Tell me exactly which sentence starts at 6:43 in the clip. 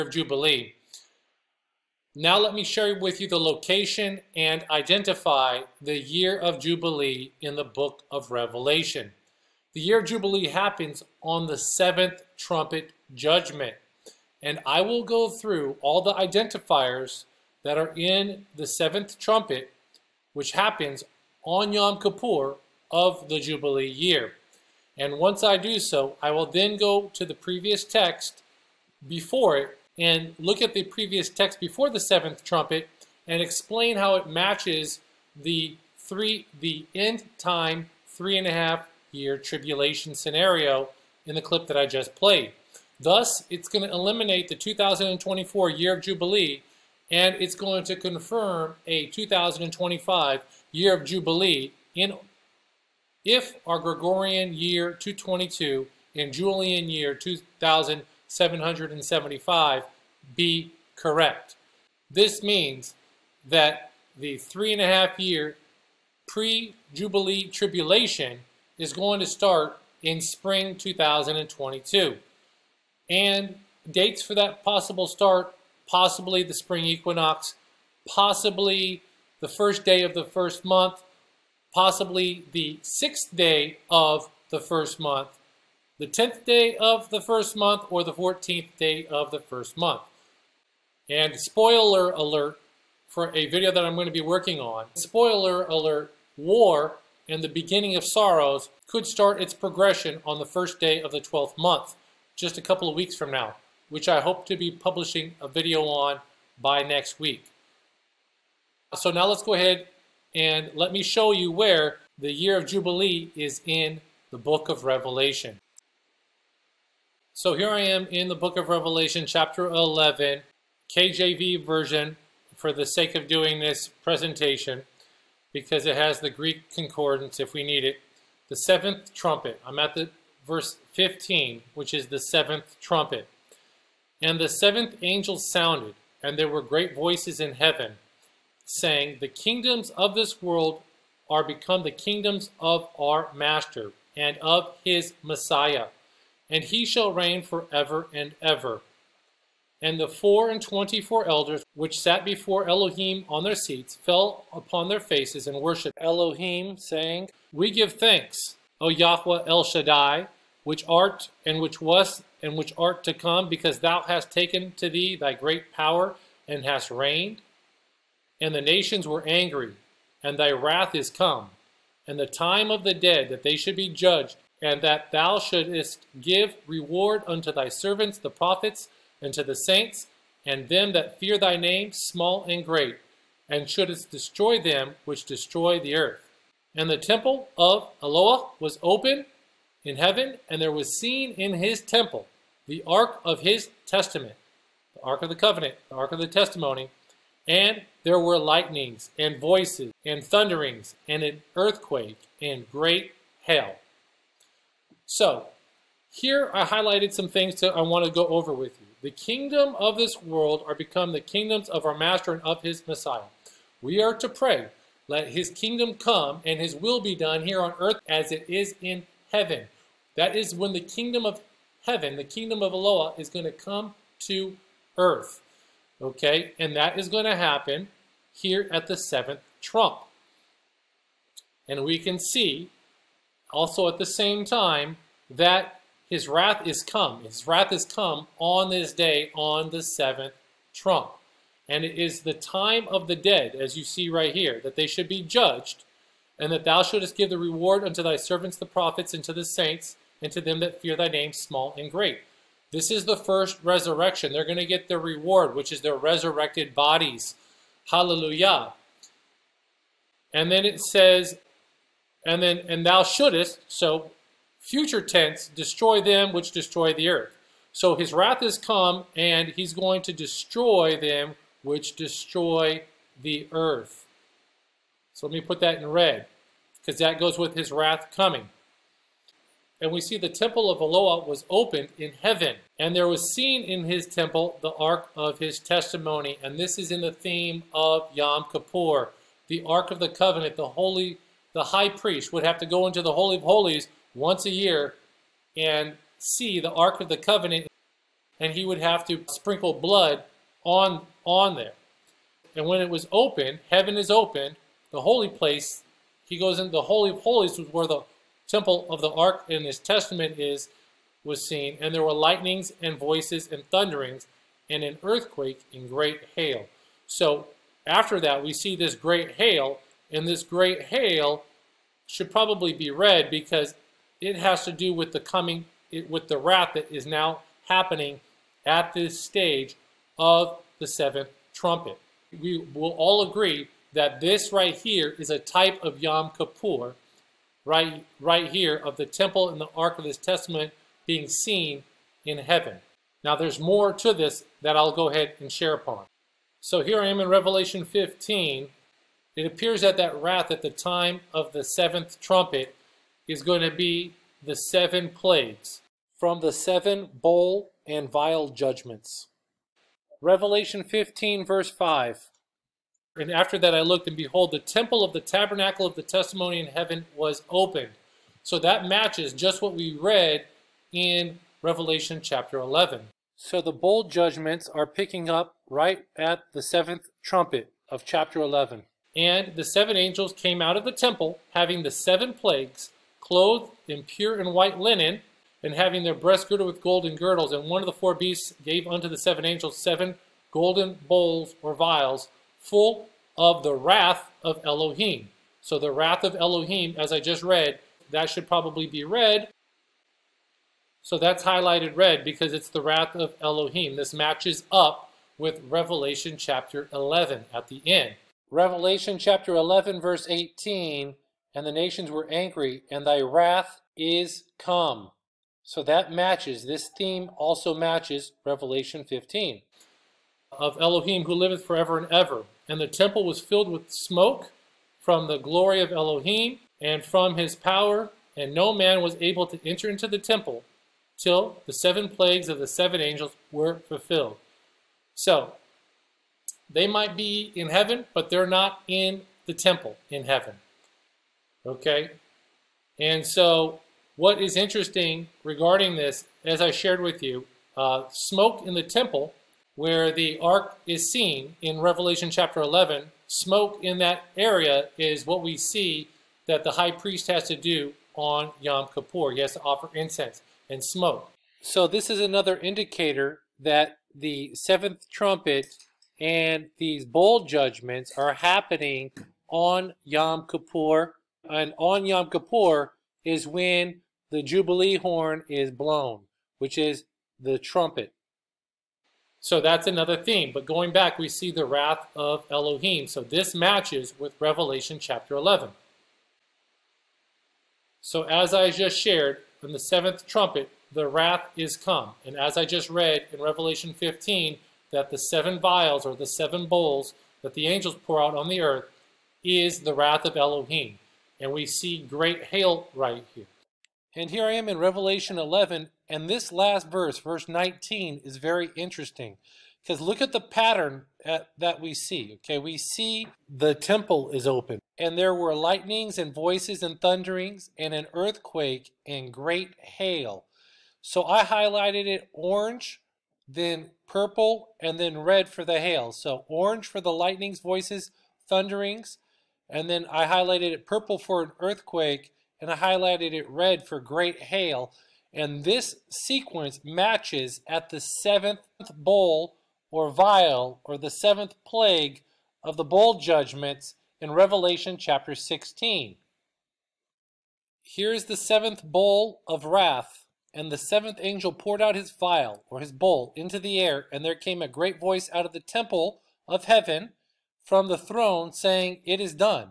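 This matches up with Revelation chapter 11 at the end.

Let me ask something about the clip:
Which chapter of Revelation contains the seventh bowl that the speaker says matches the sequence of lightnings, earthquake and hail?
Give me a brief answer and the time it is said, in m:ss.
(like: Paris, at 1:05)
Chapter 16, at 9:04.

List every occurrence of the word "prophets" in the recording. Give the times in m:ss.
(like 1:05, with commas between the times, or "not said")
2:58, 4:08.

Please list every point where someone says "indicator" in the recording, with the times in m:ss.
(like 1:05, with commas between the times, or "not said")
7:42.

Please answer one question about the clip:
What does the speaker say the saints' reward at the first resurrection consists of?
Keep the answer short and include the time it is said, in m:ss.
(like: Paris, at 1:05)
Resurrected bodies, at 4:15.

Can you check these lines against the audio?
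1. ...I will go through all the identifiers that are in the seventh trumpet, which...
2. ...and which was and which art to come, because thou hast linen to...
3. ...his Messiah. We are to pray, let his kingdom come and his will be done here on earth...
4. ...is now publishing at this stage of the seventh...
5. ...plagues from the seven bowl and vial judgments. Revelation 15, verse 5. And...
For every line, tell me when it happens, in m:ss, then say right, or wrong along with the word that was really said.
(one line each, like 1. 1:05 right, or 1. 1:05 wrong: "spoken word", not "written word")
1. 0:14 right
2. 2:41 wrong: "taken", not "linen"
3. 3:32 right
4. 5:26 wrong: "happening", not "publishing"
5. 5:55 right.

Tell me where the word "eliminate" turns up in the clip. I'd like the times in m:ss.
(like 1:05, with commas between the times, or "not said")
0:43.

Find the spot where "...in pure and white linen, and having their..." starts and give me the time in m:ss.
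6:23.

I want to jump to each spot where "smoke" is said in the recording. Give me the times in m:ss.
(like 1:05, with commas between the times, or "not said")
7:03, 7:28, 7:33, 7:40.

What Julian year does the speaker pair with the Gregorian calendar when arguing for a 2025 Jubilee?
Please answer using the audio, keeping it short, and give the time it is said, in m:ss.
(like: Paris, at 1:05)
2775, at 0:56.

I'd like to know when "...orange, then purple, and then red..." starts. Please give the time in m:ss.
8:42.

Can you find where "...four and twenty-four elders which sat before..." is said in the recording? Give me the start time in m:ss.
2:30.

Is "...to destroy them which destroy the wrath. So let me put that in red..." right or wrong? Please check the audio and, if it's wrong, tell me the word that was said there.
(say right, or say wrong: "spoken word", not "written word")
wrong: "earth", not "wrath".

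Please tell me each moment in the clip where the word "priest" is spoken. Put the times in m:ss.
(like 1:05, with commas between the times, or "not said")
4:51, 7:36.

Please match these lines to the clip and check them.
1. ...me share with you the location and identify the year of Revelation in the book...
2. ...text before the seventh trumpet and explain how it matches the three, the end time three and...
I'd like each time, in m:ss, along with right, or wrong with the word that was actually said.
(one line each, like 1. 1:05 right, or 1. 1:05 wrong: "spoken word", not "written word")
1. 0:02 wrong: "Jubilee", not "Revelation"
2. 0:31 right.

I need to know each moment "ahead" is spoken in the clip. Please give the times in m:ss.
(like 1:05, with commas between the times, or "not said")
1:49, 5:45.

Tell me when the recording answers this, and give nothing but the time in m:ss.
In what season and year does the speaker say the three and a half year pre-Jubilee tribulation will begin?
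1:10.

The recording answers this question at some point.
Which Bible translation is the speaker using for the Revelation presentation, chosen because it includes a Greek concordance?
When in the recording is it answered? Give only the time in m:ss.
2:00.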